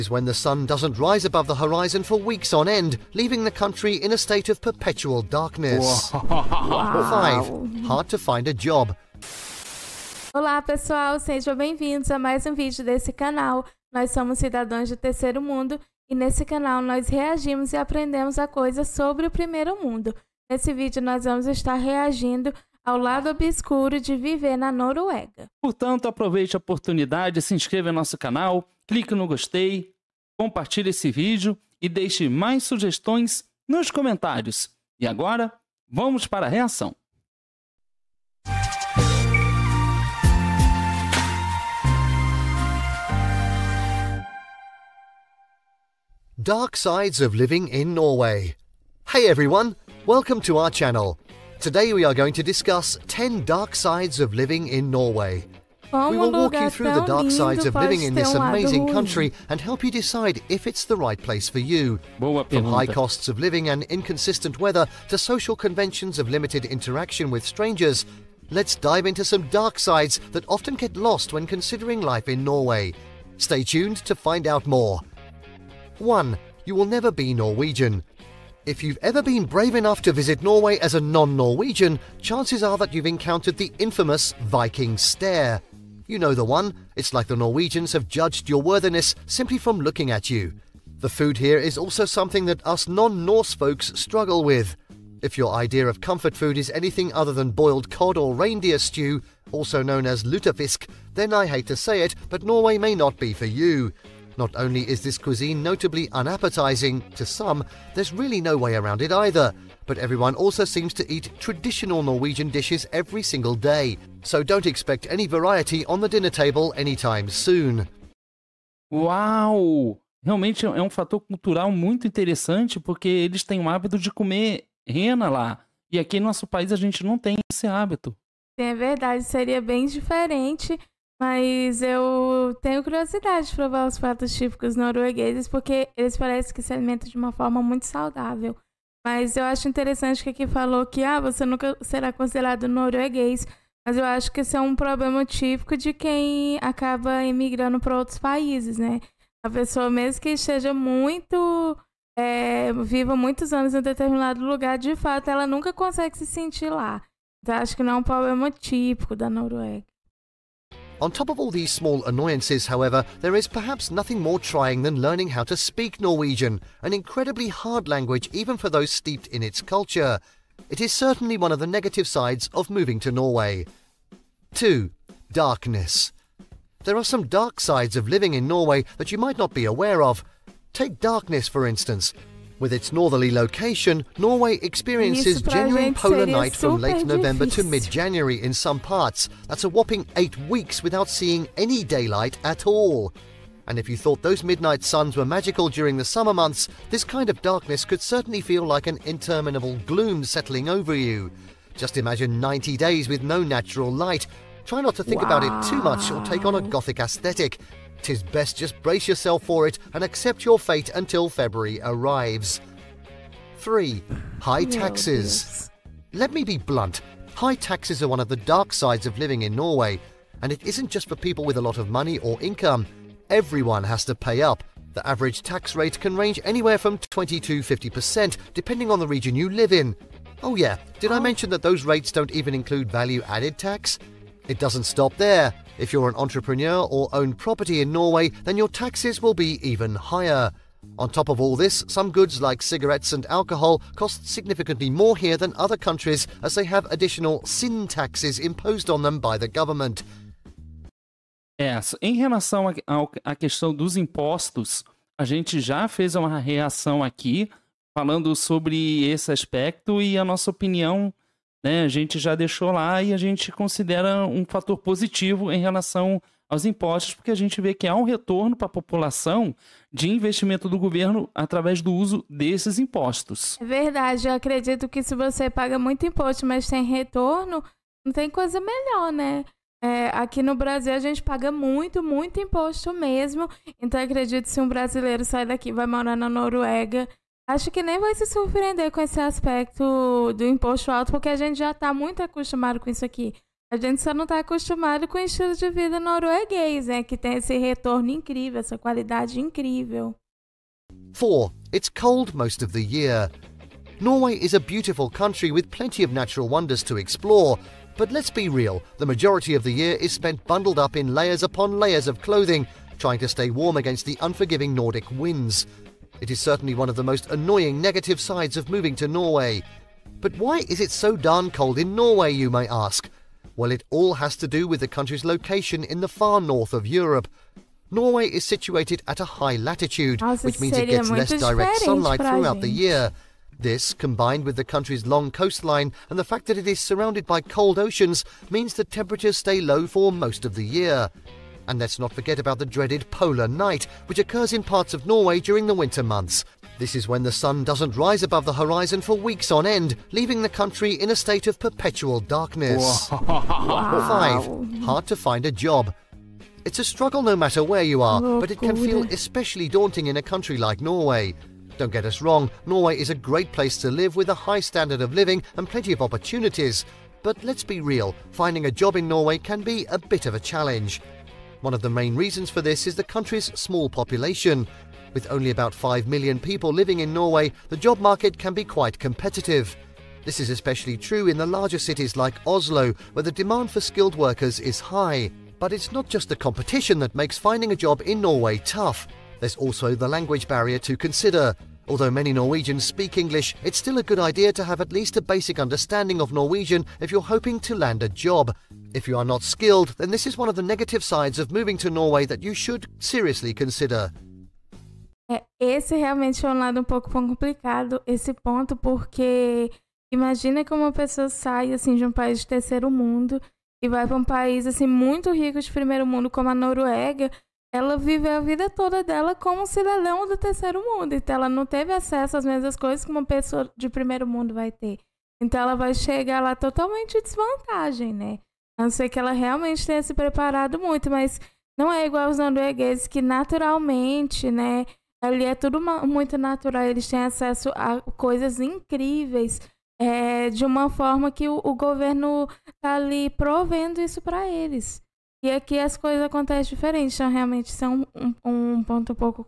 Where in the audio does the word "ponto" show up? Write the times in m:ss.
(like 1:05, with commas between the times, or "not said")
6:48, 7:28.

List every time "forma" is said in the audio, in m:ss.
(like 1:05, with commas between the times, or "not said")
2:17, 7:20.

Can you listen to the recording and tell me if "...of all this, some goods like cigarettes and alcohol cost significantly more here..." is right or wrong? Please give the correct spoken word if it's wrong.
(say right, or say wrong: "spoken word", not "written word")
right.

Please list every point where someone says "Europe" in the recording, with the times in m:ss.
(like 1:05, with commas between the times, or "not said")
5:26.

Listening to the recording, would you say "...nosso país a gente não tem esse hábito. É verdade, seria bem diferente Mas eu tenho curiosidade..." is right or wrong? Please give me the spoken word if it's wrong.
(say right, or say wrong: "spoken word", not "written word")
right.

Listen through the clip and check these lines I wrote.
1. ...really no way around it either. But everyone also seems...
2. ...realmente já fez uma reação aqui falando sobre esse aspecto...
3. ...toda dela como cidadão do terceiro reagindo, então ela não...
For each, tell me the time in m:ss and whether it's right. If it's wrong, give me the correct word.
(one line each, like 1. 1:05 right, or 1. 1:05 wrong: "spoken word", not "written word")
1. 1:48 right
2. 4:15 wrong: "gente", not "realmente"
3. 6:58 wrong: "mundo", not "reagindo".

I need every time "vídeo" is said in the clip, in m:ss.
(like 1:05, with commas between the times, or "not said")
0:12, 0:20, 0:31.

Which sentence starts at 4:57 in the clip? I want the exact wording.
Que tem esse retorno incrível, essa qualidade incrível.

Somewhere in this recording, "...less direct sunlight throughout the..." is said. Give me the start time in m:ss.
5:31.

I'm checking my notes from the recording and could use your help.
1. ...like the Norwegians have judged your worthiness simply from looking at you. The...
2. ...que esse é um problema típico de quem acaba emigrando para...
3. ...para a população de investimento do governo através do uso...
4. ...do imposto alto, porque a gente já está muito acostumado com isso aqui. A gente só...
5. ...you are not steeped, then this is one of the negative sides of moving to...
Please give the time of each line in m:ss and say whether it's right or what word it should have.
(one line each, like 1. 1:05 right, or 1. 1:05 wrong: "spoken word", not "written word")
1. 1:27 right
2. 2:24 right
3. 4:28 right
4. 4:50 right
5. 6:39 wrong: "skilled", not "steeped".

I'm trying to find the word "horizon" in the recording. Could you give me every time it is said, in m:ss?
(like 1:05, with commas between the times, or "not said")
0:01, 5:48.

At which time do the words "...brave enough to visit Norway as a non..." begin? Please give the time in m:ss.
1:19.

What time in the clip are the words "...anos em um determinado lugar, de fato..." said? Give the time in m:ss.
2:33.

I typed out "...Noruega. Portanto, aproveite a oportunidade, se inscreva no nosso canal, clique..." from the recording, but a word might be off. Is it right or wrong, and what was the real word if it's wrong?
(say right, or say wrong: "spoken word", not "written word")
right.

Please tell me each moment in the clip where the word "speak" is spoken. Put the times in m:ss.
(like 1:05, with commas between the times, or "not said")
2:45, 6:32.